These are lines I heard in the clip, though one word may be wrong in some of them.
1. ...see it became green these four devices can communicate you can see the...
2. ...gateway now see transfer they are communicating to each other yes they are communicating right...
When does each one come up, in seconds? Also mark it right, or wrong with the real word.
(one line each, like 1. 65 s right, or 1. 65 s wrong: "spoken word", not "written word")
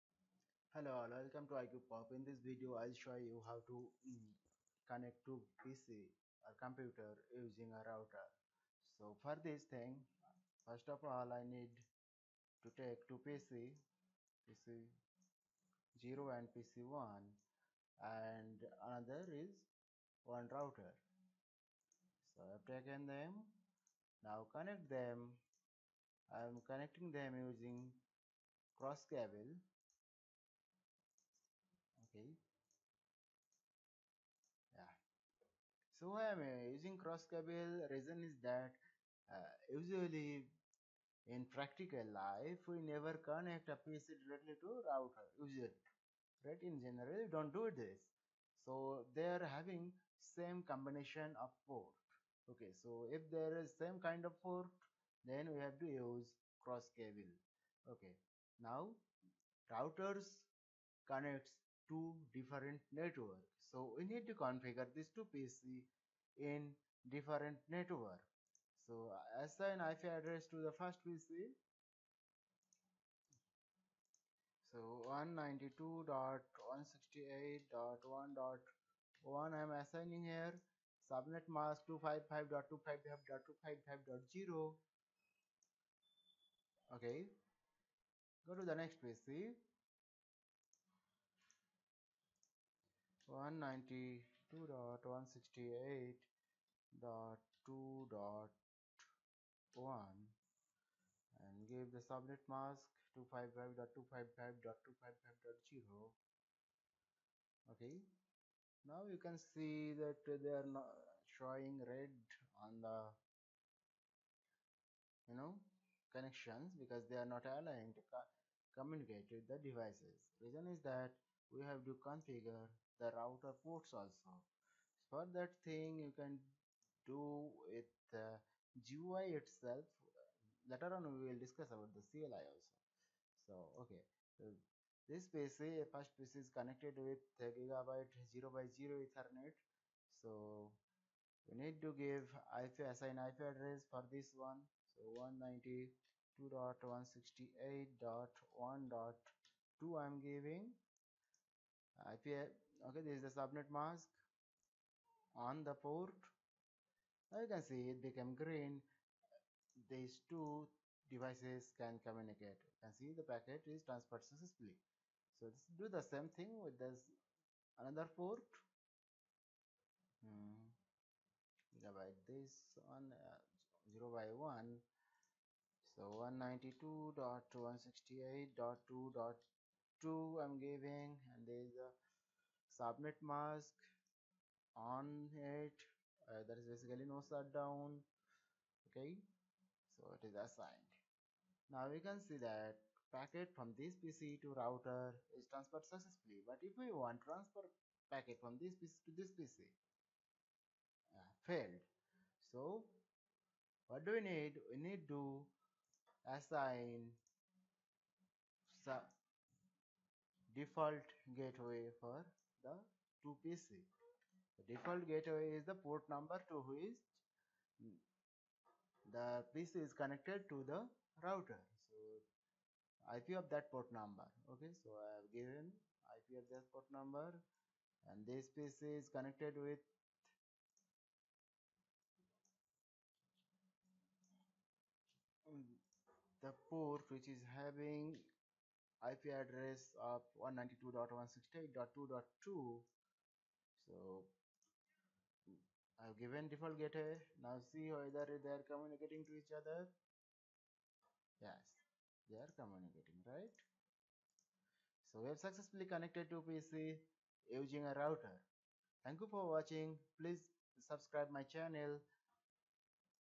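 1. 157 s wrong: "two", not "four"
2. 246 s wrong: "whether", not "transfer".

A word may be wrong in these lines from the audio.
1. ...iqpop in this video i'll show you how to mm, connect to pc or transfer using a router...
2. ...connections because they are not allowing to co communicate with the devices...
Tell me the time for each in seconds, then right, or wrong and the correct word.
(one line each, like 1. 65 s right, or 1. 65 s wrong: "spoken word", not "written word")
1. 1 s wrong: "computer", not "transfer"
2. 116 s right.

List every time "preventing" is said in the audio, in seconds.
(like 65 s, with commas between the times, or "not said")
not said.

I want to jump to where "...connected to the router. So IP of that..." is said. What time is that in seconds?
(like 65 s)
219 s.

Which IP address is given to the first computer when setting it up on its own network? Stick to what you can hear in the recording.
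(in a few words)
192.168.1.1.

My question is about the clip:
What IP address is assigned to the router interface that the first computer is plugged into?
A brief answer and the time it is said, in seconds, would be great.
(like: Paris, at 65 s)
192.168.1.2, at 146 s.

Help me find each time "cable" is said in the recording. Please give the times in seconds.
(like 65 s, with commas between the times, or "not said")
29 s, 37 s, 56 s.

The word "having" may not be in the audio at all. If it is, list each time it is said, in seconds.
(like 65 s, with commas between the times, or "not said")
49 s, 237 s.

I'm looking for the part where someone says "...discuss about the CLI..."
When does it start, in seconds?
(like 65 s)
131 s.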